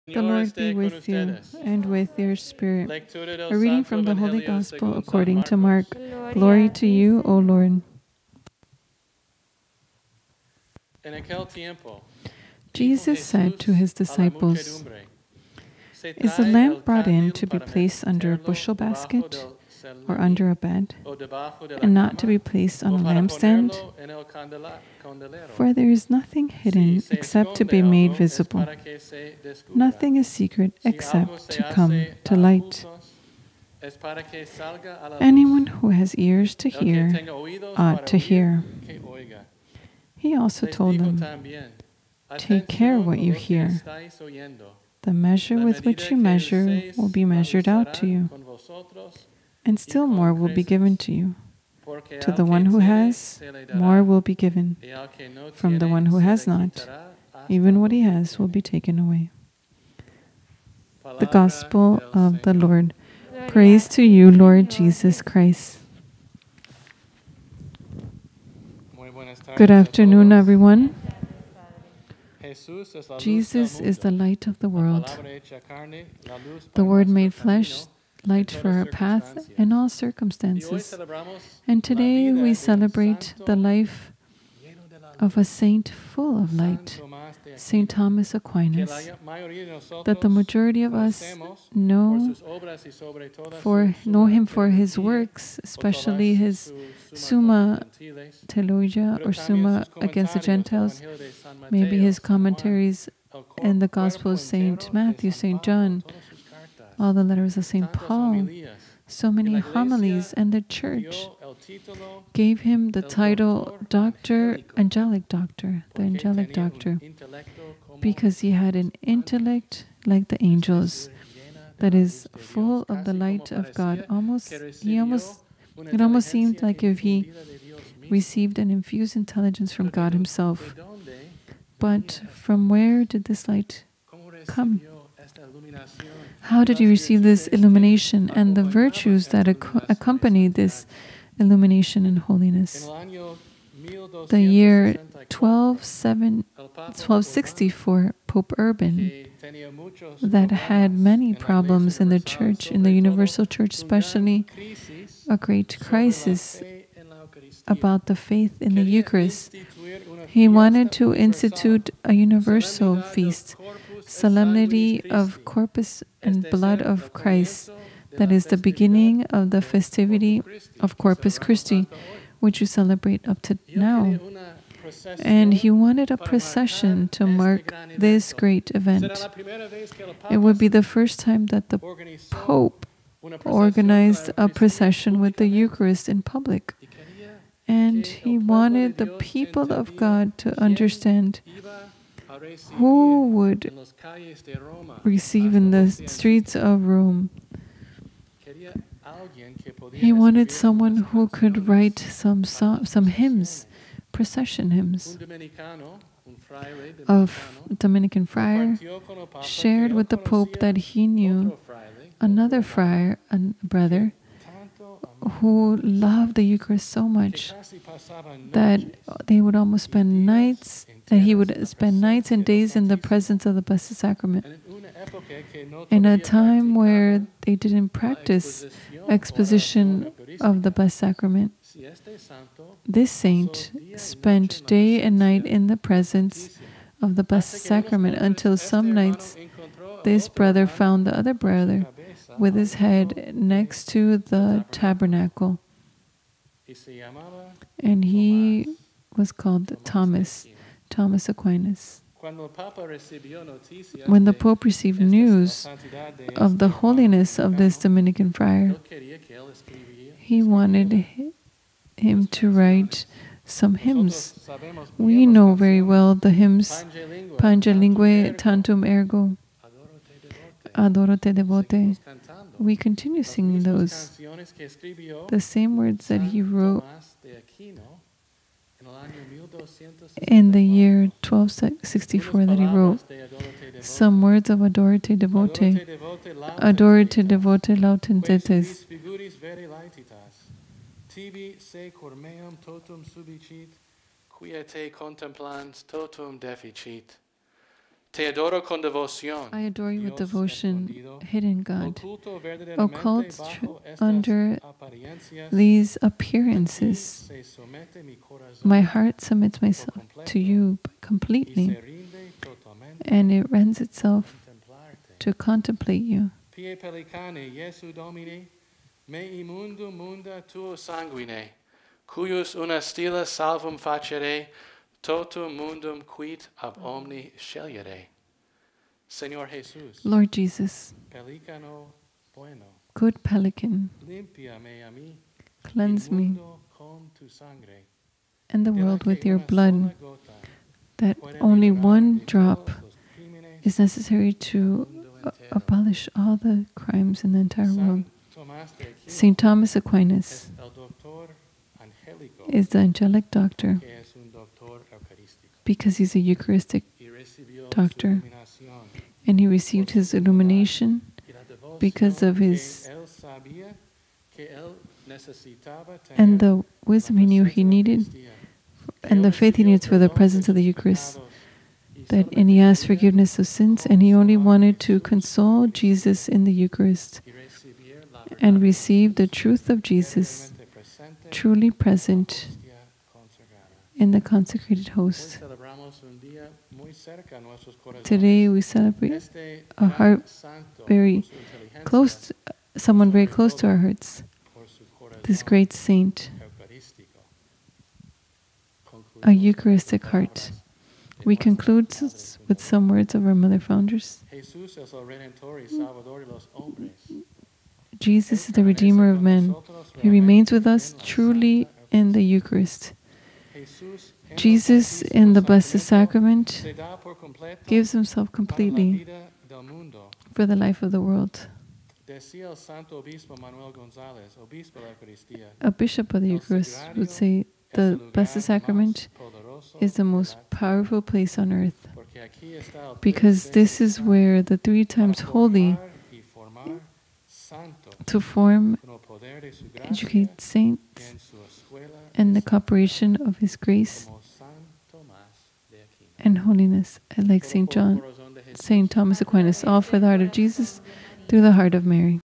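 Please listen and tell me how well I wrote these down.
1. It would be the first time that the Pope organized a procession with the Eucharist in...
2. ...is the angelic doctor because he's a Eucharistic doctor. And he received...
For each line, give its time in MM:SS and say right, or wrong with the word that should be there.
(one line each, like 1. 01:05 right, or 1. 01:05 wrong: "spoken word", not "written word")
1. 03:00 right
2. 05:52 right.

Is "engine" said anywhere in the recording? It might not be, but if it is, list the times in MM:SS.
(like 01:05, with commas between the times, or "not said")
not said.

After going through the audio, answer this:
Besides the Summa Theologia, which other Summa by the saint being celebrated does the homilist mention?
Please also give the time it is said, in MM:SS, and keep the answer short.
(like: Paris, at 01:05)
Summa Against the Gentiles, at 01:39.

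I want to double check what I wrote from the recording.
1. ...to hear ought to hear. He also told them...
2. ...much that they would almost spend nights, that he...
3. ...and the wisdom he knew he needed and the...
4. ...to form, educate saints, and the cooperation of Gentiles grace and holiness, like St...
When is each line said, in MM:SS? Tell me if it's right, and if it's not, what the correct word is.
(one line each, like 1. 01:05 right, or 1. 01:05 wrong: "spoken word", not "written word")
1. 00:36 right
2. 03:37 right
3. 06:06 right
4. 07:18 wrong: "His", not "Gentiles".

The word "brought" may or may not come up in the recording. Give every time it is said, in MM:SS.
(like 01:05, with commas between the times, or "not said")
00:16.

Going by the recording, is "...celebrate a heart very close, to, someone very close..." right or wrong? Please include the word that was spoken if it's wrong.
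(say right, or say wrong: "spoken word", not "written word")
right.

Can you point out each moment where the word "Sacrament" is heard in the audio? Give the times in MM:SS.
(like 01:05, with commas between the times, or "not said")
03:43, 03:50, 03:57, 06:55, 07:08.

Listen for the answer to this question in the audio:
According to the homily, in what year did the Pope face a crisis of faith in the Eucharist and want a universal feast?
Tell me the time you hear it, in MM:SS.
02:25.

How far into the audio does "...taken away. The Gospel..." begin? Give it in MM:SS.
00:58.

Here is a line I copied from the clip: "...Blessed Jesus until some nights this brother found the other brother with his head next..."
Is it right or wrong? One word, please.
wrong.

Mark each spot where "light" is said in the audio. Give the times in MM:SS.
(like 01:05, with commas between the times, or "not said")
00:32, 01:14, 01:18, 01:26, 02:03, 02:13.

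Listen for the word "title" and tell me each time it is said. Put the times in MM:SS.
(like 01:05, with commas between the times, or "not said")
01:53.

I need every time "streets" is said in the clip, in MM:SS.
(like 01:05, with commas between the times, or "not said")
03:15.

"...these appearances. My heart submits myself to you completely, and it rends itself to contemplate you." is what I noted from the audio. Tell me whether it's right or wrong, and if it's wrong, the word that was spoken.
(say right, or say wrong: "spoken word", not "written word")
right.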